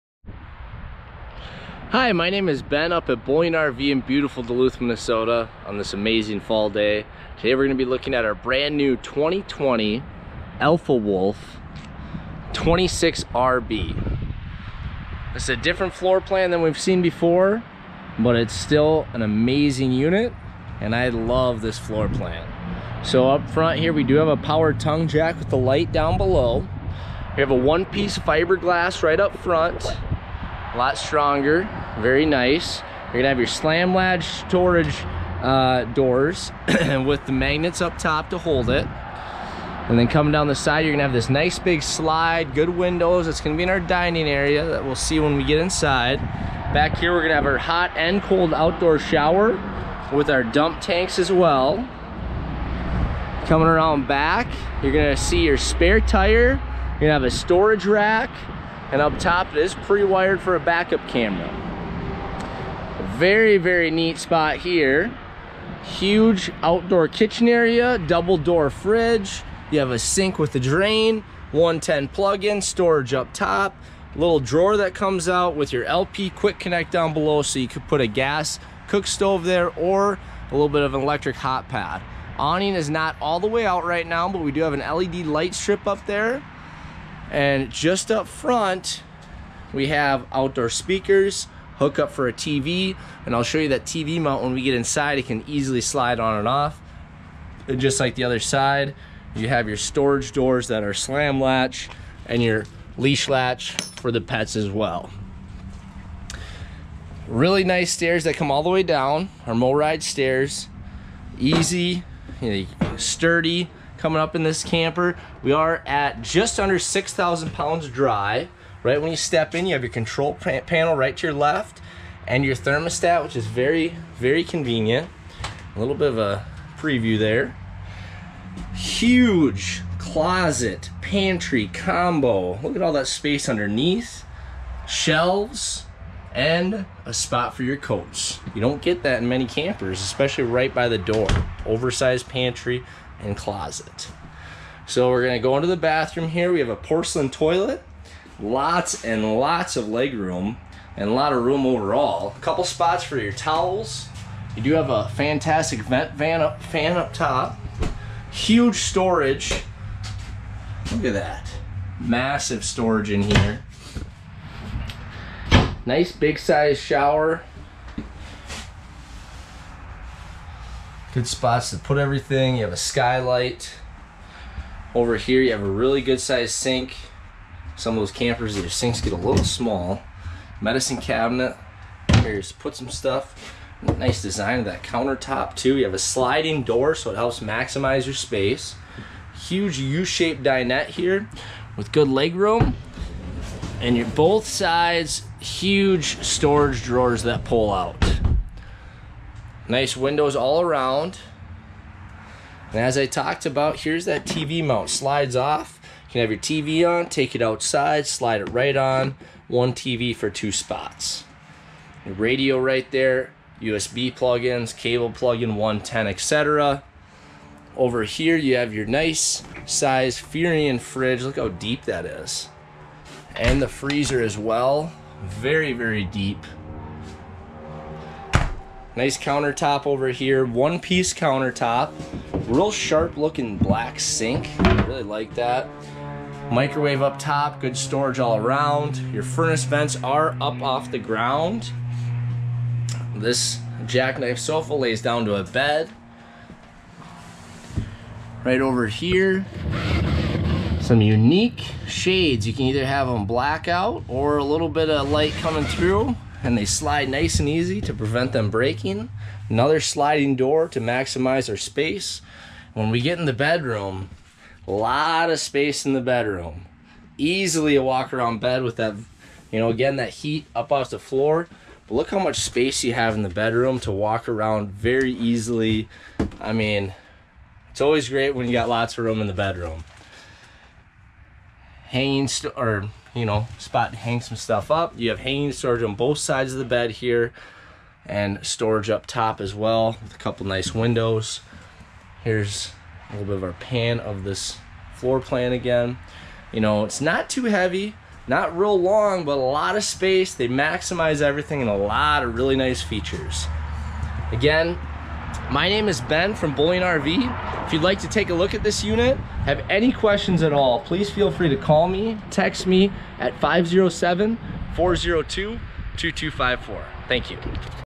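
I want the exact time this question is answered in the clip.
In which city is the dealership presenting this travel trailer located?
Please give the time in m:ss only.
0:04.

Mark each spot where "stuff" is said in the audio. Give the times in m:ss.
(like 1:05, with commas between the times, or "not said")
3:02, 4:44.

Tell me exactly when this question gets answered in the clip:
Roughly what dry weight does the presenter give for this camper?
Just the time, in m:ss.
1:56.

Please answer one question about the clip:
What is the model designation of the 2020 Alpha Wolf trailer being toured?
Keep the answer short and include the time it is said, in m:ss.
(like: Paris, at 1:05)
26RB, at 0:12.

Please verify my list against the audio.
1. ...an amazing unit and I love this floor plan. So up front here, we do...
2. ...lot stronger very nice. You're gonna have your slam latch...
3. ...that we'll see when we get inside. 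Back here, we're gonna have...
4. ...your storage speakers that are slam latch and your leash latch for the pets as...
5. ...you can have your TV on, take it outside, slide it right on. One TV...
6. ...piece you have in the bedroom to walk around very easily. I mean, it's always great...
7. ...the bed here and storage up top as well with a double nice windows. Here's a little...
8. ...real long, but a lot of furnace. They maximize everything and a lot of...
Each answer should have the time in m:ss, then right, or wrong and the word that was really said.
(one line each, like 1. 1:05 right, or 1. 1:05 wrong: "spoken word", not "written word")
1. 0:19 right
2. 0:30 right
3. 0:44 right
4. 1:39 wrong: "doors", not "speakers"
5. 3:26 right
6. 4:32 wrong: "space", not "piece"
7. 4:46 wrong: "couple", not "double"
8. 4:58 wrong: "space", not "furnace".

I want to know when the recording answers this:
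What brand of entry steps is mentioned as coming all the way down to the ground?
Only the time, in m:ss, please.
1:49.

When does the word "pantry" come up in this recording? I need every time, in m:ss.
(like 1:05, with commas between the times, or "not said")
2:11, 2:22.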